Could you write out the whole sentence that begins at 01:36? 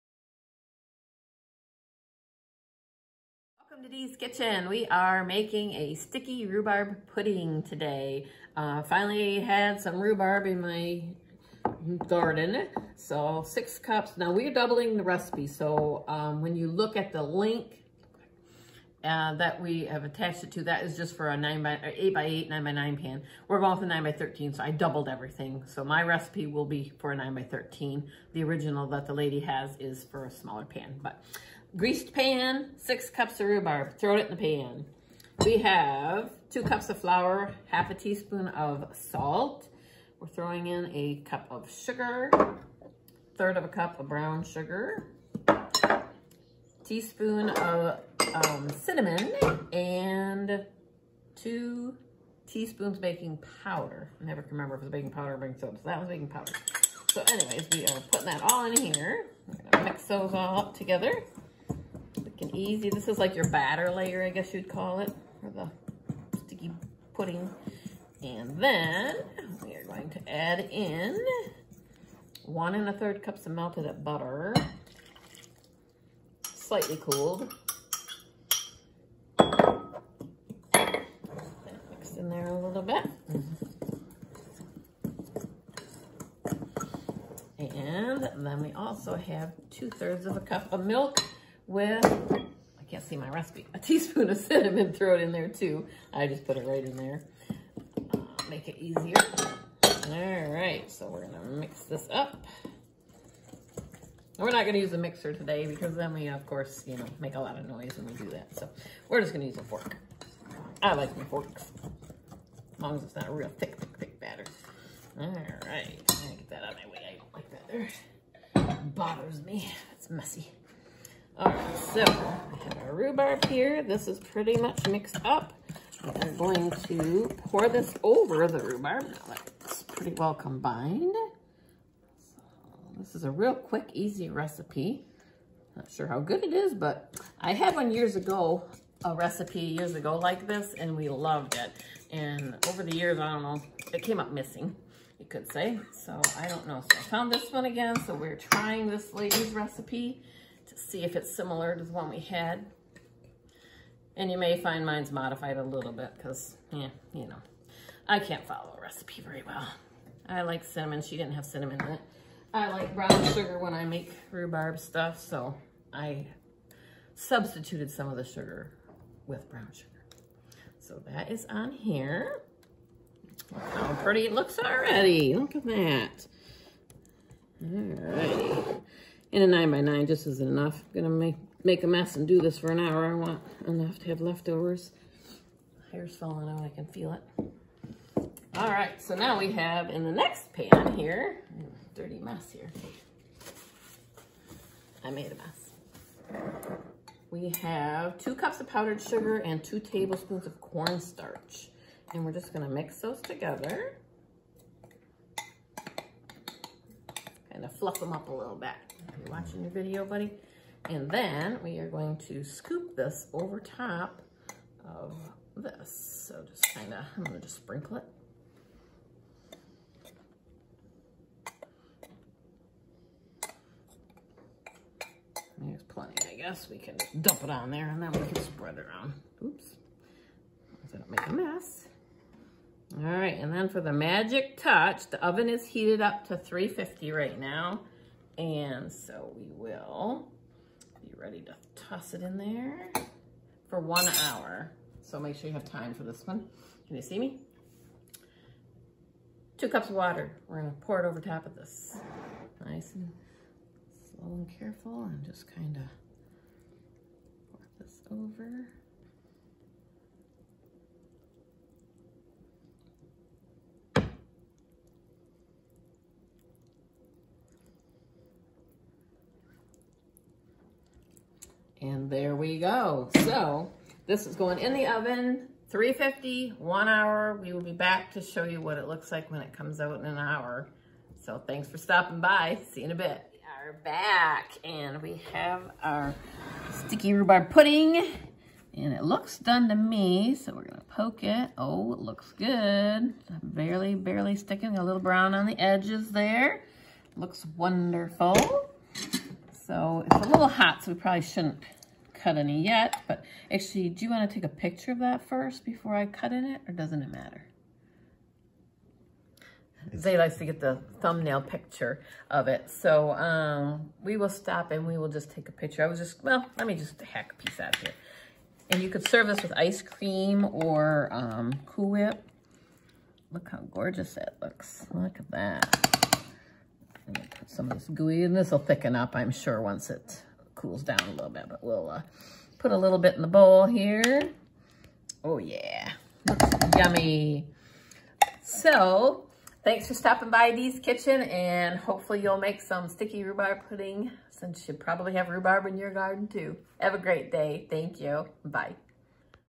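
I just put it right in there, uh, make it easier.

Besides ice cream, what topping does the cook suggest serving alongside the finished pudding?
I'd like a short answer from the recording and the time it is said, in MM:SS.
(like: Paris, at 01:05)
Cool Whip, at 05:21.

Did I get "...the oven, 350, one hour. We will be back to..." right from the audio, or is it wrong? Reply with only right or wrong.
right.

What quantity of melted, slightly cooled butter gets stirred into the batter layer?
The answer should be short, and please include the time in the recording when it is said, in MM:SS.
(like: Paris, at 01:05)
1 1/3 cups, at 01:12.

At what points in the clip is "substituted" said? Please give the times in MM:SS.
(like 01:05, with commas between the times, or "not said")
02:47.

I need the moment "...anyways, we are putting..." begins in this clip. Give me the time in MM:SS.
00:57.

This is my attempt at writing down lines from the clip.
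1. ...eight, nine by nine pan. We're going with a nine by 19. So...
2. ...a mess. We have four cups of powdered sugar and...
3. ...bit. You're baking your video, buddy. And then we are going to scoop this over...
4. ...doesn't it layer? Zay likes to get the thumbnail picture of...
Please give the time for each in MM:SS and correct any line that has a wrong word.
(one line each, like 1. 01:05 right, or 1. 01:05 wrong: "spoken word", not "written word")
1. 00:22 wrong: "13", not "19"
2. 03:15 wrong: "two", not "four"
3. 03:28 wrong: "watching", not "baking"
4. 05:06 wrong: "matter", not "layer".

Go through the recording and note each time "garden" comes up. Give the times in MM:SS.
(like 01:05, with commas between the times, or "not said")
00:12, 05:45.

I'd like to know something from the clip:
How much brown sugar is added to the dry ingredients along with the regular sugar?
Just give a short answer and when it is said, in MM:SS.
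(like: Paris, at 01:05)
1/3 cup, at 00:43.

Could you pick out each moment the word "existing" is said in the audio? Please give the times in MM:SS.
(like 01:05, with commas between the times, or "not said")
not said.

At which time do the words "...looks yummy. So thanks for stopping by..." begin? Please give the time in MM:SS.
05:36.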